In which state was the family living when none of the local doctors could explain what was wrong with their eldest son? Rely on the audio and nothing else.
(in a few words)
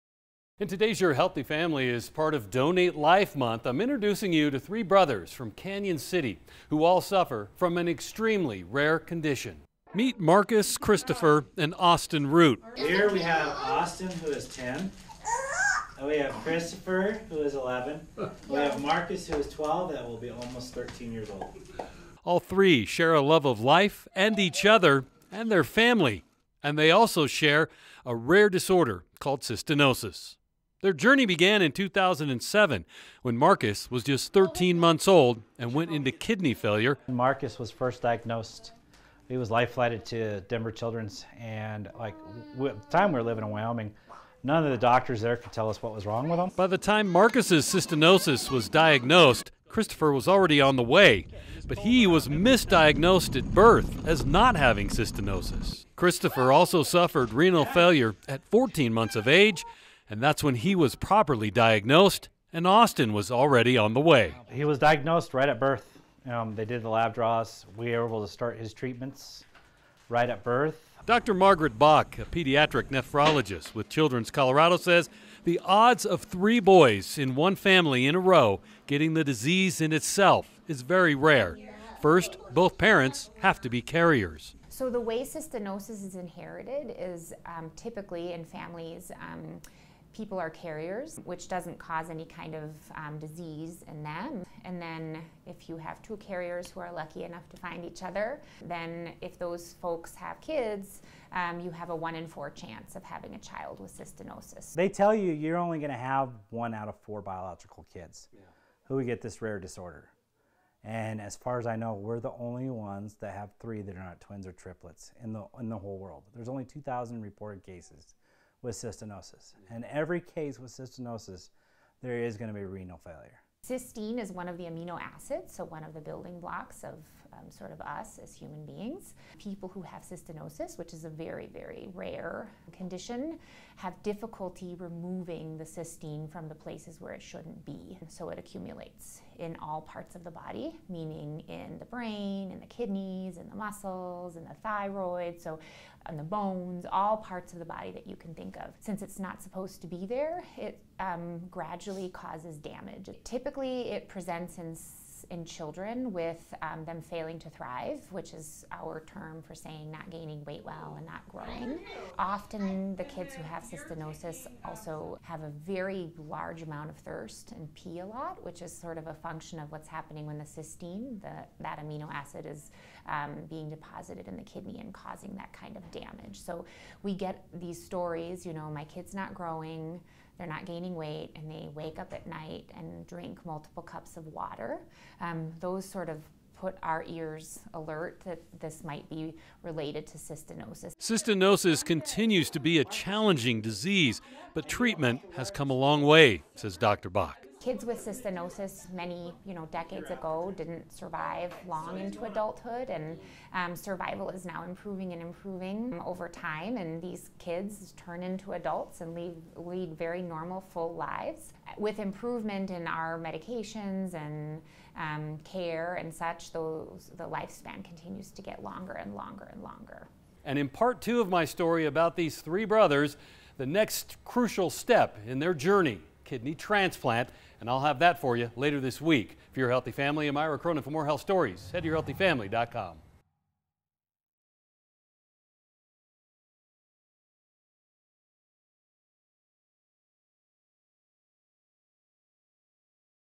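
Wyoming.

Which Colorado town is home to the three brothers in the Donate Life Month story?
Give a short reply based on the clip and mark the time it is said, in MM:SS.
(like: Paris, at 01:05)
Canon City, at 00:05.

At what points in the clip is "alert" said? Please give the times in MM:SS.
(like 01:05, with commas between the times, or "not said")
03:07.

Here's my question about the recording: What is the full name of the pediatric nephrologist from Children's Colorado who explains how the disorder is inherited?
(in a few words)
Margaret Bach.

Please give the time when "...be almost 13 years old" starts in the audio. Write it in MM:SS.
00:20.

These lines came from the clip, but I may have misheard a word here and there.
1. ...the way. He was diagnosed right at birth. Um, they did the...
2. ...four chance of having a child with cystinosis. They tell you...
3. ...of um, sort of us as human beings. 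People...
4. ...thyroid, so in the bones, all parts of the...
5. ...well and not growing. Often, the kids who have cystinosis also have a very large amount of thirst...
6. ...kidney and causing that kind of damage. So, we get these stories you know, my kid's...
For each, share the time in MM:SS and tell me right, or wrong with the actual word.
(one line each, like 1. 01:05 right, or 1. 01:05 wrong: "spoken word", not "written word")
1. 01:03 right
2. 01:42 right
3. 02:06 right
4. 02:24 right
5. 02:40 right
6. 02:54 right.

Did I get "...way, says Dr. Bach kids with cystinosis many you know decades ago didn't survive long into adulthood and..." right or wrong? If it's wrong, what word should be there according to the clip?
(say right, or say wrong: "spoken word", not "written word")
right.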